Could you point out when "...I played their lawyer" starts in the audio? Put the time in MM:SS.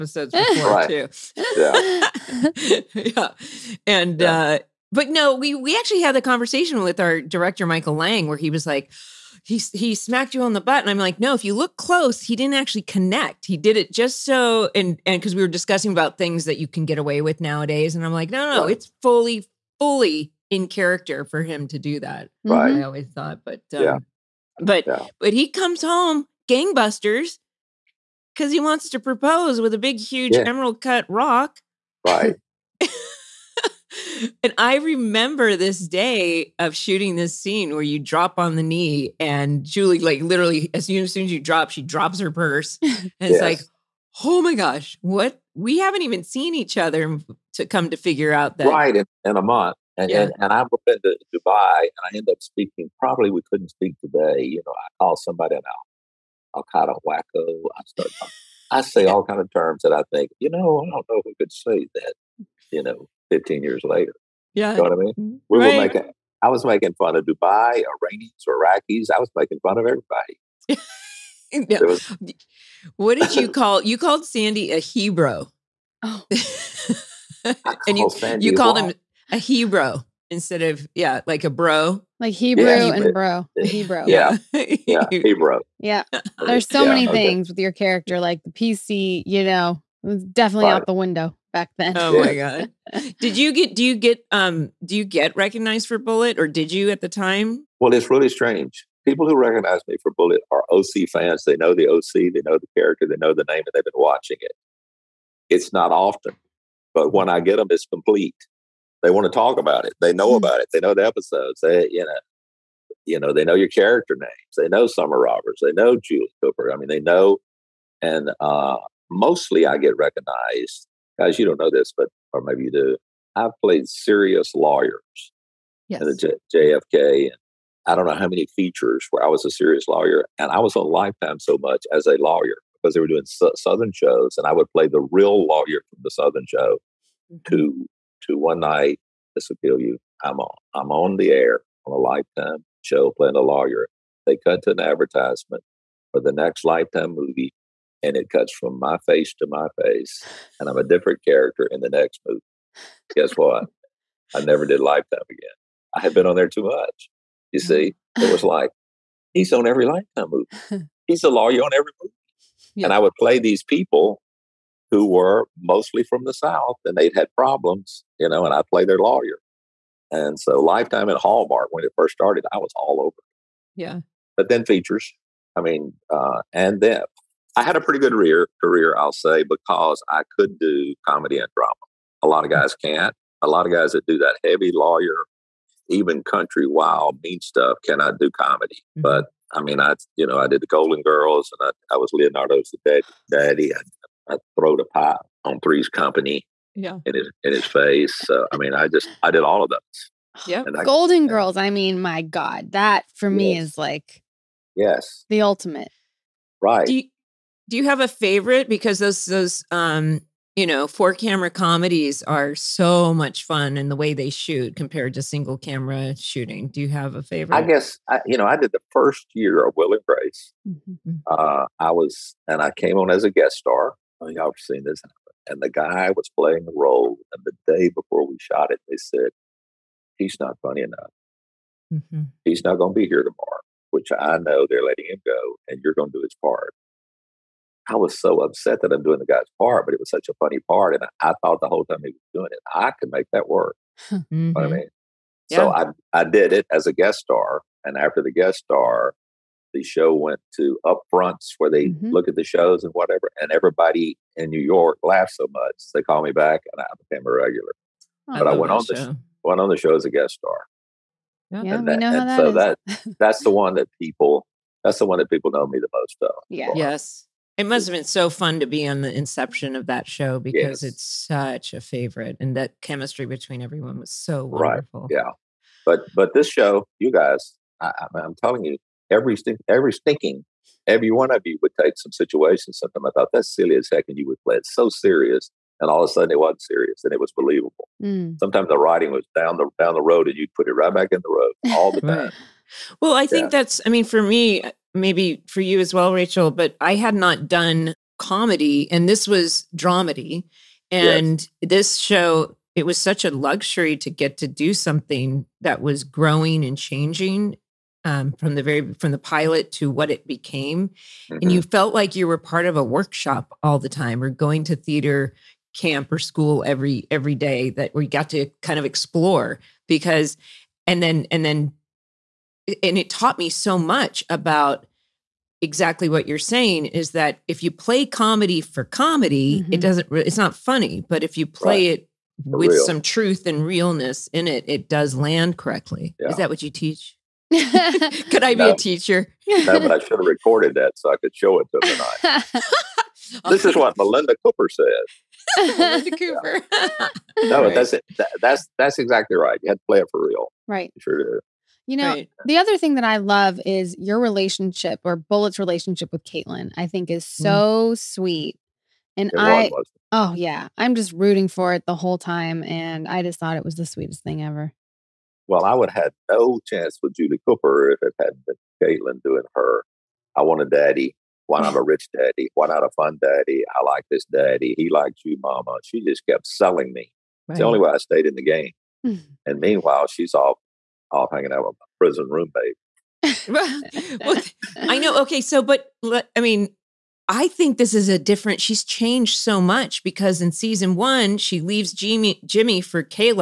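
02:48.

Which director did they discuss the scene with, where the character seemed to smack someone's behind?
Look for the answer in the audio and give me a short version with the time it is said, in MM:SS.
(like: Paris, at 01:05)
Michael Lange, at 00:07.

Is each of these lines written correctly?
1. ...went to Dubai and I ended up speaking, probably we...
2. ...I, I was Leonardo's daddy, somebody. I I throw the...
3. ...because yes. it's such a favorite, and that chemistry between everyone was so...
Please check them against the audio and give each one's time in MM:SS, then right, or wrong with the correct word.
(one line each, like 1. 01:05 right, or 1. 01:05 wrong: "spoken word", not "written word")
1. 00:50 right
2. 03:11 wrong: "daddy", not "somebody"
3. 04:30 right.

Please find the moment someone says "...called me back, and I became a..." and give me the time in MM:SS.
04:16.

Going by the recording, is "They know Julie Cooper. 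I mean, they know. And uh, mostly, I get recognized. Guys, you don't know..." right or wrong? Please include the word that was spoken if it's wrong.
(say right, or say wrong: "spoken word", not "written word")
right.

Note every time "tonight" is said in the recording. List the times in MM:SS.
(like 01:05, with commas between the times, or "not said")
05:42.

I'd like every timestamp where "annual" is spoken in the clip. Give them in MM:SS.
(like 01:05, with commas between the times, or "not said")
not said.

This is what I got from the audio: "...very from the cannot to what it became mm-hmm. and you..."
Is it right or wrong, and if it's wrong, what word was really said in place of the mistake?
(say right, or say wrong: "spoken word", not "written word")
wrong: "pilot", not "cannot".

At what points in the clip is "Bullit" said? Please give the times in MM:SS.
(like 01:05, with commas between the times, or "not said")
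01:35, 01:40, 05:55.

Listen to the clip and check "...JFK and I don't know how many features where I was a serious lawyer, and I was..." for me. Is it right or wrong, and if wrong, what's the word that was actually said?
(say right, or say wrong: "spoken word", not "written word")
right.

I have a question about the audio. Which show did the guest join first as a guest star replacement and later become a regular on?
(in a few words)
Will and Grace.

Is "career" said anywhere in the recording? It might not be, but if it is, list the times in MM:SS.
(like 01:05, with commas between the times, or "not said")
02:58.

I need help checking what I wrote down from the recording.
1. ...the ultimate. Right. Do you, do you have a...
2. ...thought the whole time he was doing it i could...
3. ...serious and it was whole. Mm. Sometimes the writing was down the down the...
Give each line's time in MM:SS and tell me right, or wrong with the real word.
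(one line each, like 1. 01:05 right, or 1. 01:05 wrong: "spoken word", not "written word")
1. 03:25 right
2. 04:01 right
3. 04:46 wrong: "believable", not "whole".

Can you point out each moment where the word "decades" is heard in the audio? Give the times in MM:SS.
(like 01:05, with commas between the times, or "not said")
not said.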